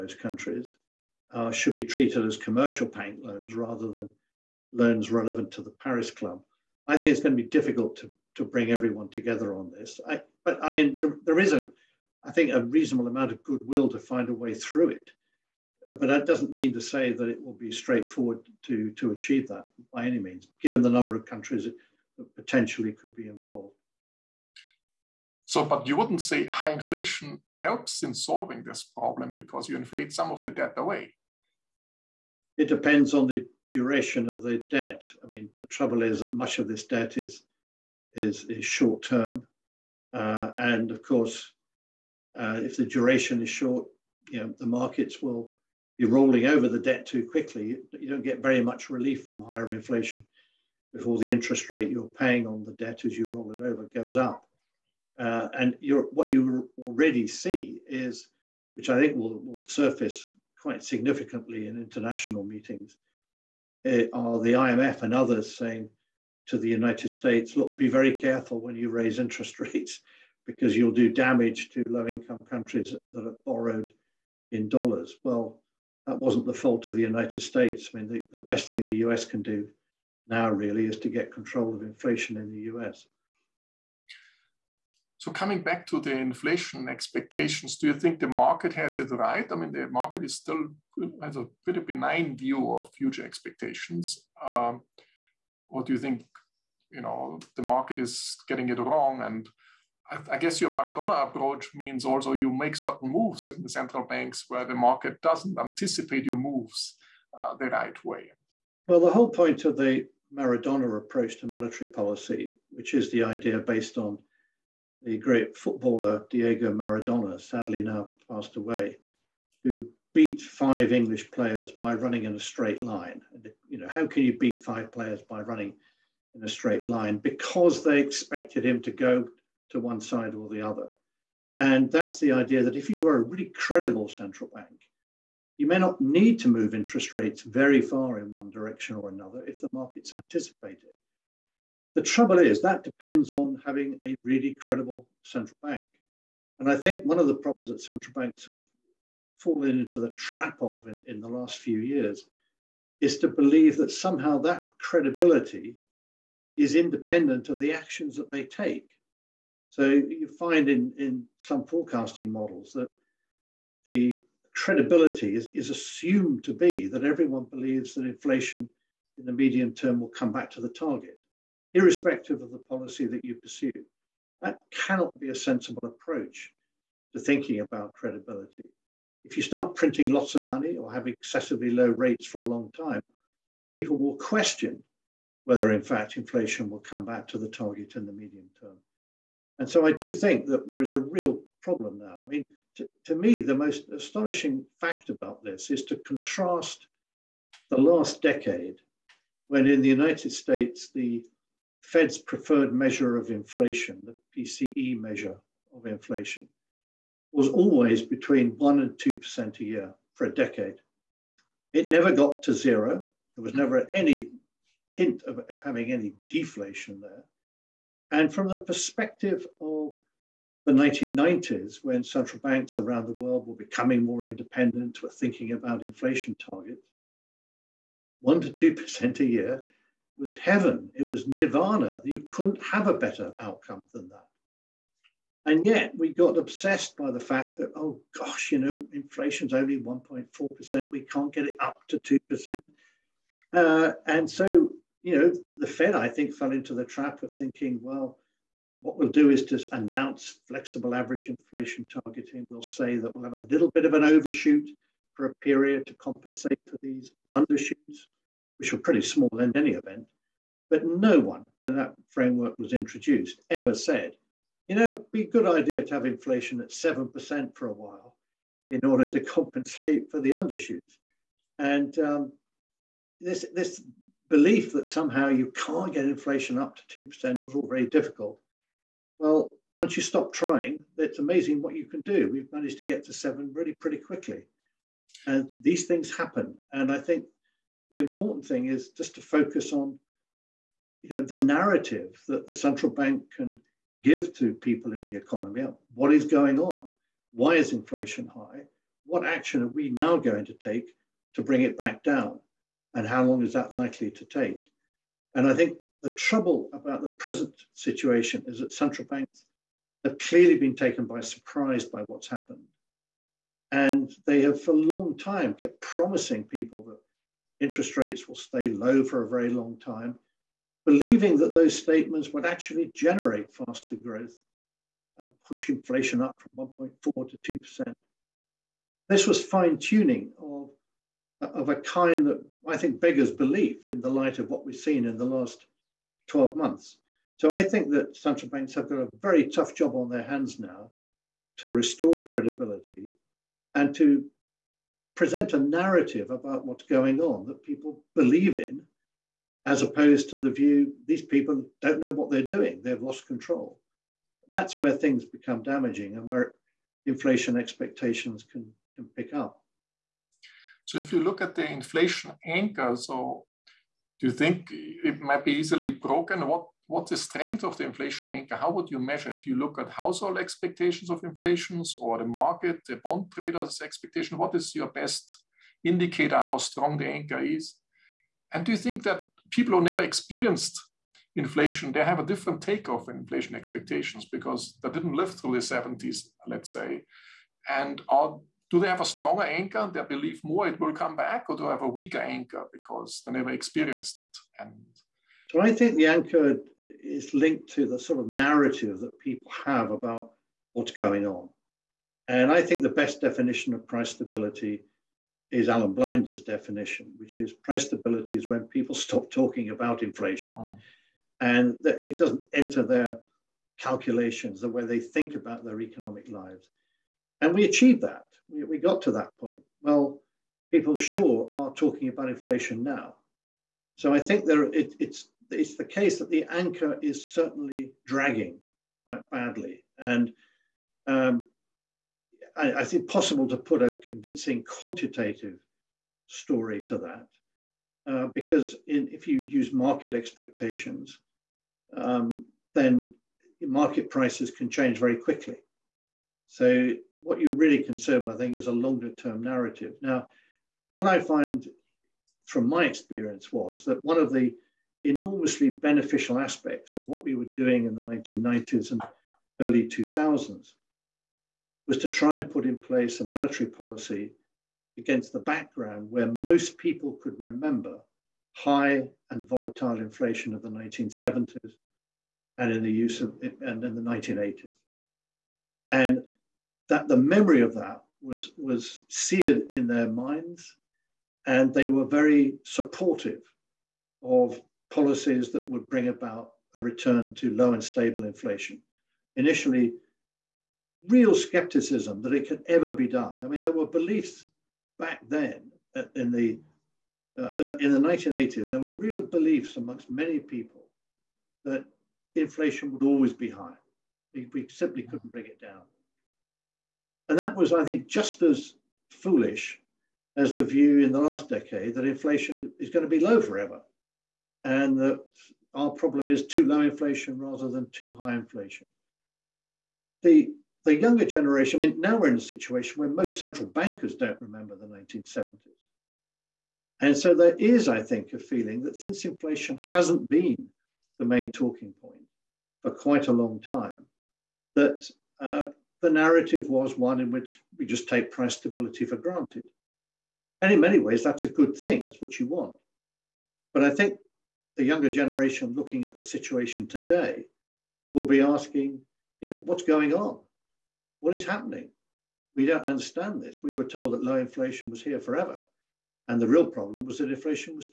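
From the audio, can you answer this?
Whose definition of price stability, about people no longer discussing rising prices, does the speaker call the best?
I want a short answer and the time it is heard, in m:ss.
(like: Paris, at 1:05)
Alan Blinder, at 6:45.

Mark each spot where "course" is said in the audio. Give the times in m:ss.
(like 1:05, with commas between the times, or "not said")
0:41.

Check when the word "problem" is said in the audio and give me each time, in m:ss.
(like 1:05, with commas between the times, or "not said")
0:28, 2:27, 3:11, 8:35, 9:16.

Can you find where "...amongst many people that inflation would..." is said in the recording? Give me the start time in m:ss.
8:19.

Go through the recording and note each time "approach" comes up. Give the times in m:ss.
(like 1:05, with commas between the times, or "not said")
1:41, 1:50, 2:55.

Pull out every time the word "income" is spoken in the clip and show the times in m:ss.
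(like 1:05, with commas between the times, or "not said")
1:12.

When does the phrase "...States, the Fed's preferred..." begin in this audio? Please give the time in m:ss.
3:20.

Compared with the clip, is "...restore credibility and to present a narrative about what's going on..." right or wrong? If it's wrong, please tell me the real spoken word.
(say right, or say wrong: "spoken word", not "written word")
right.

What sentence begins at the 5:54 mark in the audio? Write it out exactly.
That's where things become damaging and where inflation expectations can, can pick up.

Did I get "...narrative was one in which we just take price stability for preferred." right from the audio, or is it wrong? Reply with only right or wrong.
wrong.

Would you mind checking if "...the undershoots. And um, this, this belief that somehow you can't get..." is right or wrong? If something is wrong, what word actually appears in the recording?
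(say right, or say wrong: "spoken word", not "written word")
right.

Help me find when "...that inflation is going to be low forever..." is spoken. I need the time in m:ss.
8:31.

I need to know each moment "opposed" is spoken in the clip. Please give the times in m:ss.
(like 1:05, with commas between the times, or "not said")
5:49.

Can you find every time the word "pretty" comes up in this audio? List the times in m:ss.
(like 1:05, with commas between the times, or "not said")
1:31, 4:18, 4:43.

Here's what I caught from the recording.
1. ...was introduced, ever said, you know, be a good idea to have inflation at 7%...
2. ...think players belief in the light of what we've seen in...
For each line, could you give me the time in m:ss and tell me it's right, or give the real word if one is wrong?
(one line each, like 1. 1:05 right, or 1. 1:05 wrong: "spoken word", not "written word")
1. 4:22 right
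2. 5:32 wrong: "beggars", not "players".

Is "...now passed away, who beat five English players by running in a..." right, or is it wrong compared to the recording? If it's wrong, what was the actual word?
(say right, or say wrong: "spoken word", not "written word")
right.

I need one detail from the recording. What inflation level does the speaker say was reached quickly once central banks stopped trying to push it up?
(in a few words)
7%.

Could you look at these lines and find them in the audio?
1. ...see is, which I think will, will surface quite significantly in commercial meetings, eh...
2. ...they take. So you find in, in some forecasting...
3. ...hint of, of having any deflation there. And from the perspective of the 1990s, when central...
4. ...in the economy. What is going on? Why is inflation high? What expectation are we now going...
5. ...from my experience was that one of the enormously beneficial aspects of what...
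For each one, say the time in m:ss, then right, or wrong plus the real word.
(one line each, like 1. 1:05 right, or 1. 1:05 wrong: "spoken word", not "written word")
1. 0:57 wrong: "international", not "commercial"
2. 2:38 right
3. 3:34 right
4. 4:54 wrong: "action", not "expectation"
5. 7:32 right.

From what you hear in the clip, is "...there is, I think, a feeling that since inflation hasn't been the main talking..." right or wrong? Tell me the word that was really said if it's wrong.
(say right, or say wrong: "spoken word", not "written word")
right.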